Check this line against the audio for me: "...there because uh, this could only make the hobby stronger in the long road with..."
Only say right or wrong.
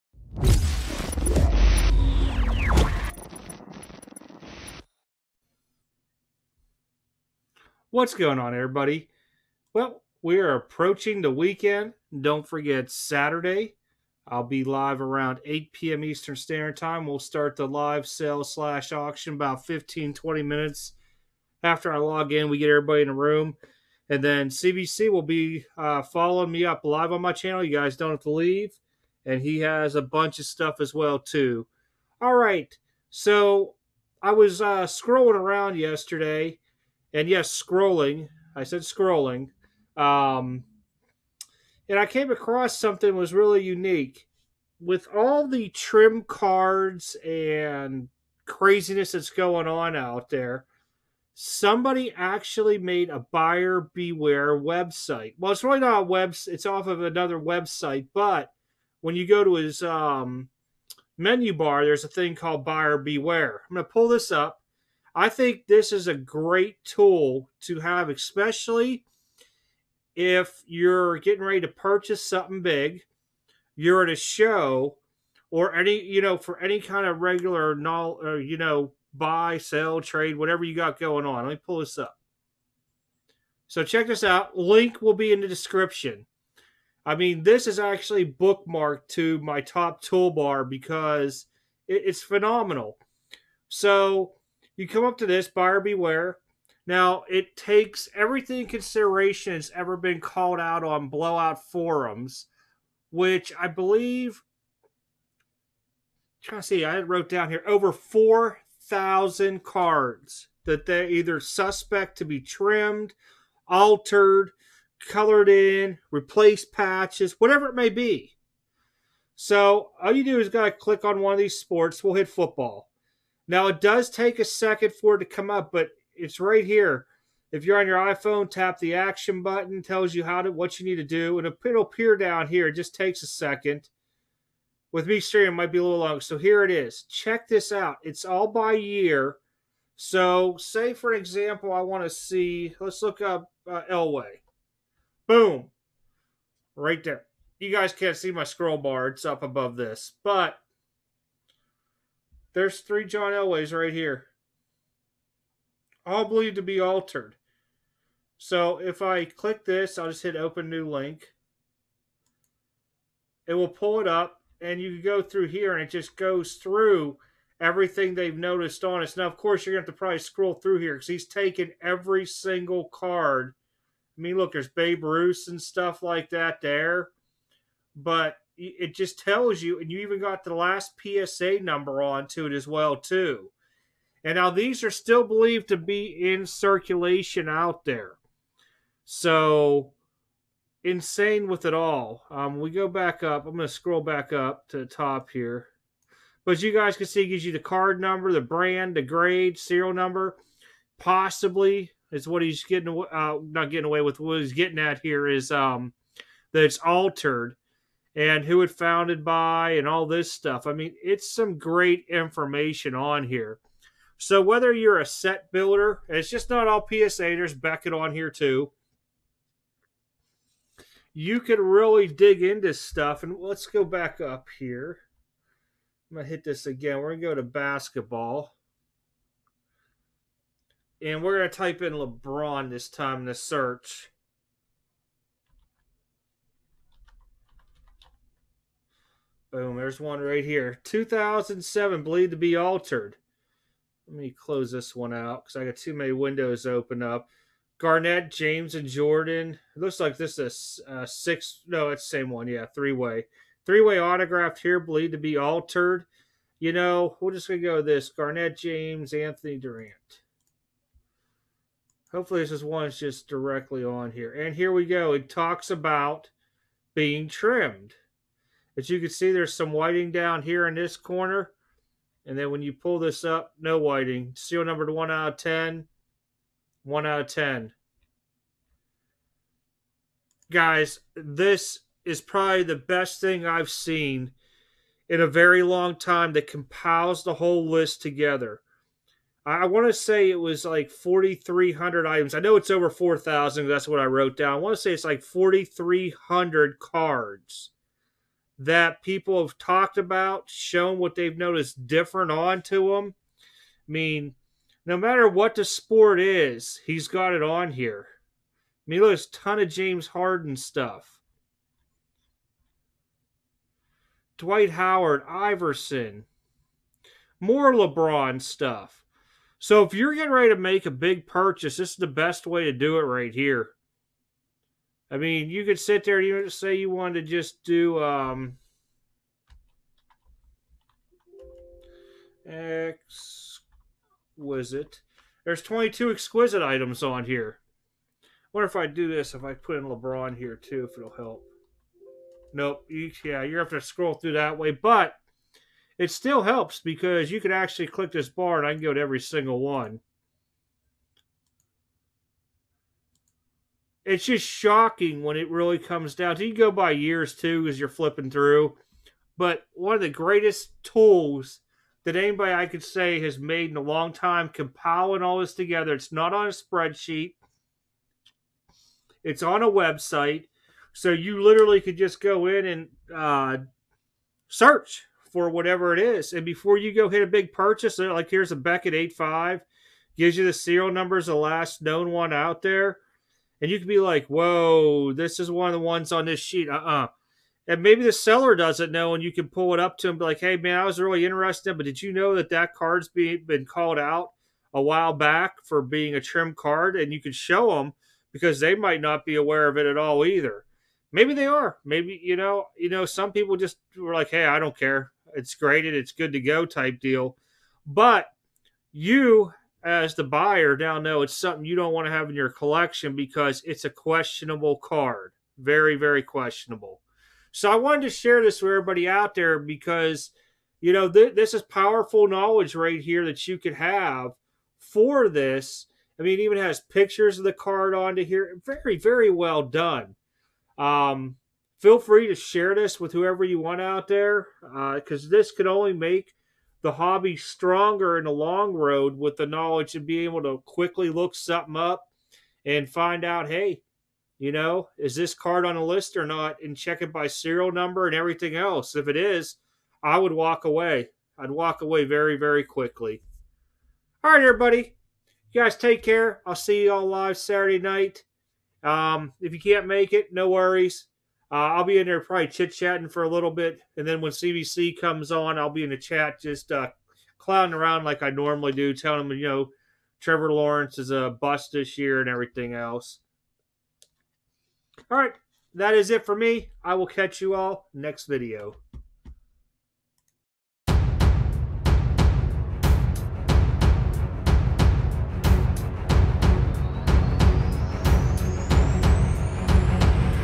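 right.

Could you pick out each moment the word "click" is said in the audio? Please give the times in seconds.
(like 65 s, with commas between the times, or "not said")
120 s, 159 s, 347 s.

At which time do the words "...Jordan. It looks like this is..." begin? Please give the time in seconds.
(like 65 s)
248 s.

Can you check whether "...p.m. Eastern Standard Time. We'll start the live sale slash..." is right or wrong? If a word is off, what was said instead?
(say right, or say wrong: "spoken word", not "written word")
right.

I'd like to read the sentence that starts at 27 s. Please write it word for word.
You guys don't have to leave.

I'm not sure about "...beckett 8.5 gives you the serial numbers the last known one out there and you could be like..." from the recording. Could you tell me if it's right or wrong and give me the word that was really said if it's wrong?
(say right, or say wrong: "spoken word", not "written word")
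right.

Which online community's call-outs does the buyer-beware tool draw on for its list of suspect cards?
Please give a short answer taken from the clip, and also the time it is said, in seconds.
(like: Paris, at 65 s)
Blowout forums, at 101 s.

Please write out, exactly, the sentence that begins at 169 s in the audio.
Now, of course, you're going to have to probably scroll through here because he's taken every single card.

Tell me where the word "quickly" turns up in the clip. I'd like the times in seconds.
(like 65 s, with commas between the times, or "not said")
440 s, 452 s.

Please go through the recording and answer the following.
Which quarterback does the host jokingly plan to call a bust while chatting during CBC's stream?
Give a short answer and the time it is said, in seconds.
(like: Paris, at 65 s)
Trevor Lawrence, at 470 s.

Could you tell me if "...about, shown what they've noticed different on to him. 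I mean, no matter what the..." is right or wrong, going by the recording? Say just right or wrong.
right.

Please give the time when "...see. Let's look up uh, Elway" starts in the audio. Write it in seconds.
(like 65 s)
142 s.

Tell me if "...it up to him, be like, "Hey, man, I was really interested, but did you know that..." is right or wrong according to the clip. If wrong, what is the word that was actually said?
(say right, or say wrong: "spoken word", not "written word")
right.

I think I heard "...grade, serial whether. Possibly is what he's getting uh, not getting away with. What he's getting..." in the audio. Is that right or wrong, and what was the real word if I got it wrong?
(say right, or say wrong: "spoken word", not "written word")
wrong: "number", not "whether".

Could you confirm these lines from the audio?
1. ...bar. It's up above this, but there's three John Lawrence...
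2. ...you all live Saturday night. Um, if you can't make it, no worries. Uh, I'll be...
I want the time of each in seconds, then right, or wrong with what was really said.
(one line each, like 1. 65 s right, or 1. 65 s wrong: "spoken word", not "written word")
1. 148 s wrong: "Elways", not "Lawrence"
2. 456 s right.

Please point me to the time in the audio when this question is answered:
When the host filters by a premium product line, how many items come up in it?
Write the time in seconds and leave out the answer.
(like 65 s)
335 s.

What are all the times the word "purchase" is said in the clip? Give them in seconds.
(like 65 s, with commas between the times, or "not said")
71 s, 321 s, 377 s.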